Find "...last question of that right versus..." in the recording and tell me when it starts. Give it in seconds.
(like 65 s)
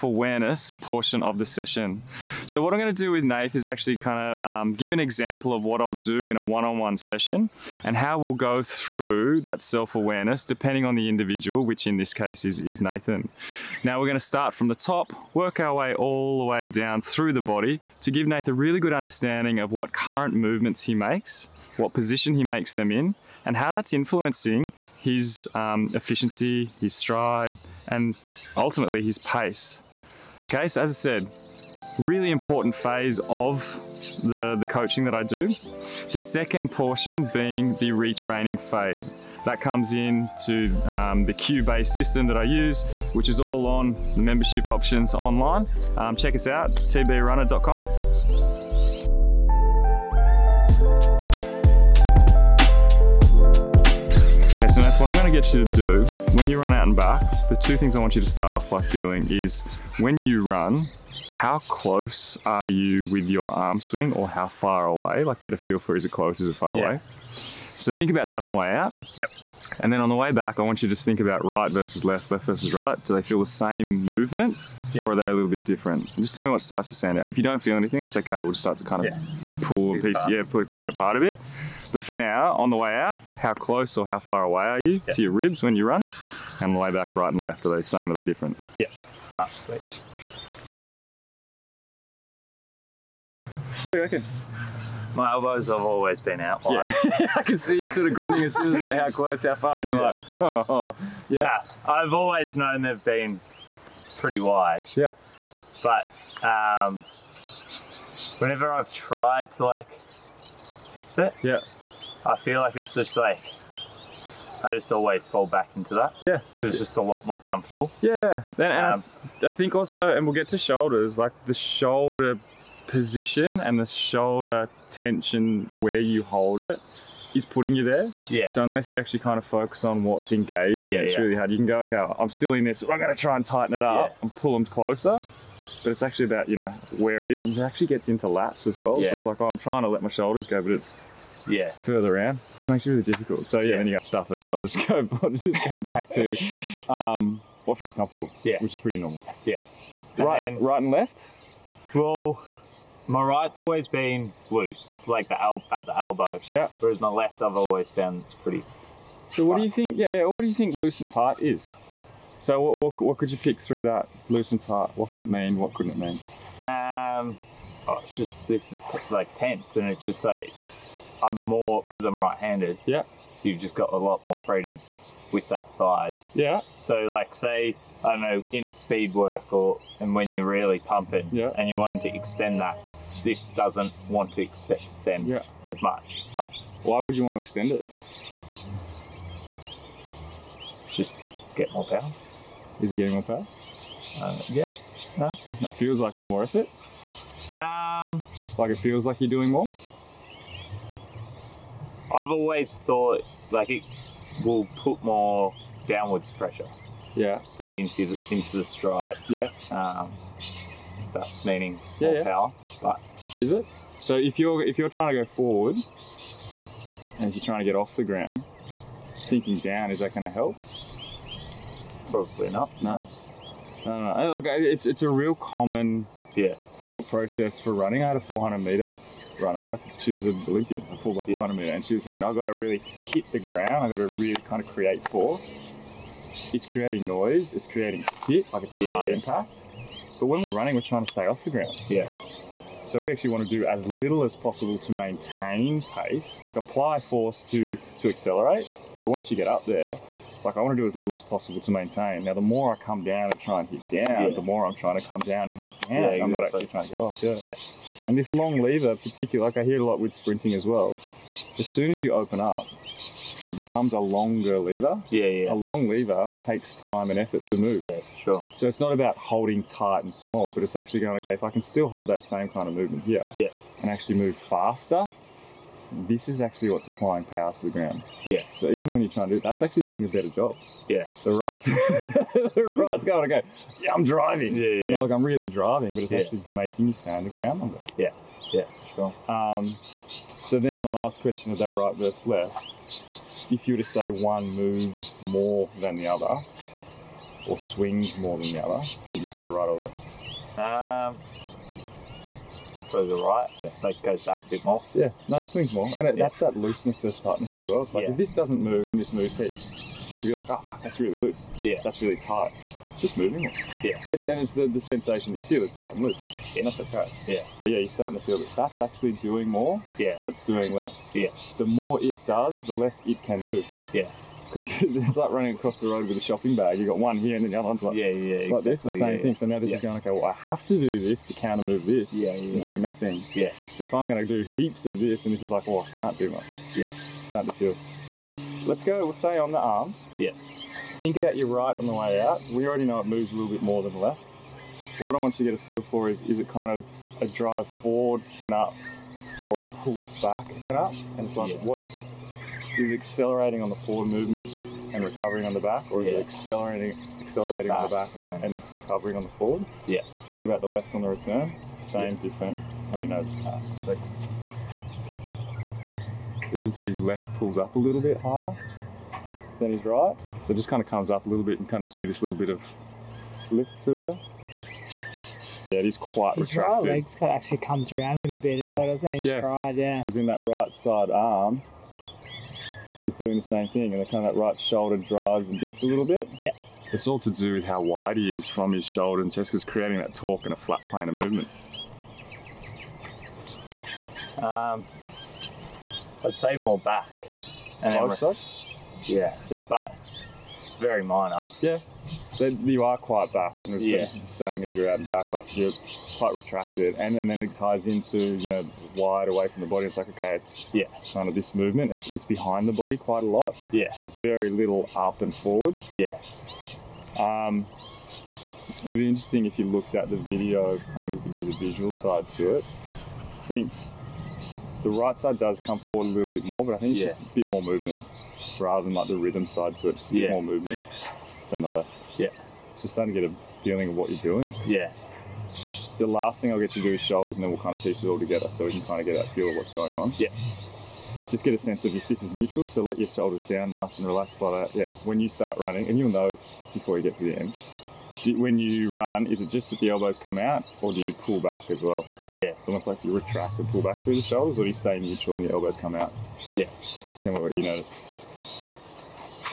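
290 s.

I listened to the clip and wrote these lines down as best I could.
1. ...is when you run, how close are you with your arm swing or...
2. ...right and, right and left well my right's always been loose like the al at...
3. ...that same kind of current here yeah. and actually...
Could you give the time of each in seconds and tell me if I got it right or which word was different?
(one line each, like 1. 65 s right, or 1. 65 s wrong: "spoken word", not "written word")
1. 59 s right
2. 150 s right
3. 272 s wrong: "movement", not "current".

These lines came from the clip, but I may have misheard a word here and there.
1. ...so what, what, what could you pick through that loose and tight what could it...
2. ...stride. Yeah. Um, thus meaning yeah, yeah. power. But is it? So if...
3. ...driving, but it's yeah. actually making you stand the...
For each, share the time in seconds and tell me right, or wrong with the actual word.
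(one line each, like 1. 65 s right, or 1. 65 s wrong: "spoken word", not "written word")
1. 162 s right
2. 208 s right
3. 285 s right.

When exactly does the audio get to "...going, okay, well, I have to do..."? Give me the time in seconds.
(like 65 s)
329 s.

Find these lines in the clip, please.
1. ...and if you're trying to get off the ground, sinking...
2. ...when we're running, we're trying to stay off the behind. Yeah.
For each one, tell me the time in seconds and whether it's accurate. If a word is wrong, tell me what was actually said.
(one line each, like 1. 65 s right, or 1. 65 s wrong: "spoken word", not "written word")
1. 217 s right
2. 240 s wrong: "ground", not "behind".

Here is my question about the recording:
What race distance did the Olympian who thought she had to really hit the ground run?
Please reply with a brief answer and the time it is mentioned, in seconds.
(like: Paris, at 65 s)
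400 meters, at 228 s.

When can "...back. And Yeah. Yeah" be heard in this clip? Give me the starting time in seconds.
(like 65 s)
396 s.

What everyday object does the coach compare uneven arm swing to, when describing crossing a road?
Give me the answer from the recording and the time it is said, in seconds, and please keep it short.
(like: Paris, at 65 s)
shopping bag, at 326 s.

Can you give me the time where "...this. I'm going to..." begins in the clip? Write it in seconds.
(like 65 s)
132 s.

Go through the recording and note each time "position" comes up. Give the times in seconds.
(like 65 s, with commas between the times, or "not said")
21 s, 122 s.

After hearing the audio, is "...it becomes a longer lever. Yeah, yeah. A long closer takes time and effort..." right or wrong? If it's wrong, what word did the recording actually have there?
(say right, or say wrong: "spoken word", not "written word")
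wrong: "lever", not "closer".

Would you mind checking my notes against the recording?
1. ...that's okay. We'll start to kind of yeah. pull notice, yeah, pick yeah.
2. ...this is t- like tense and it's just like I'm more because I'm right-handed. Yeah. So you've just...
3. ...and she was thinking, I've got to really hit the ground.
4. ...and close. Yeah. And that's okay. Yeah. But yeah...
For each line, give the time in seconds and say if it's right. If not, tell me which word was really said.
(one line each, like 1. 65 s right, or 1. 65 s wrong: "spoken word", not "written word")
1. 77 s wrong: "piece", not "notice"
2. 168 s right
3. 231 s right
4. 315 s wrong: "loose", not "close".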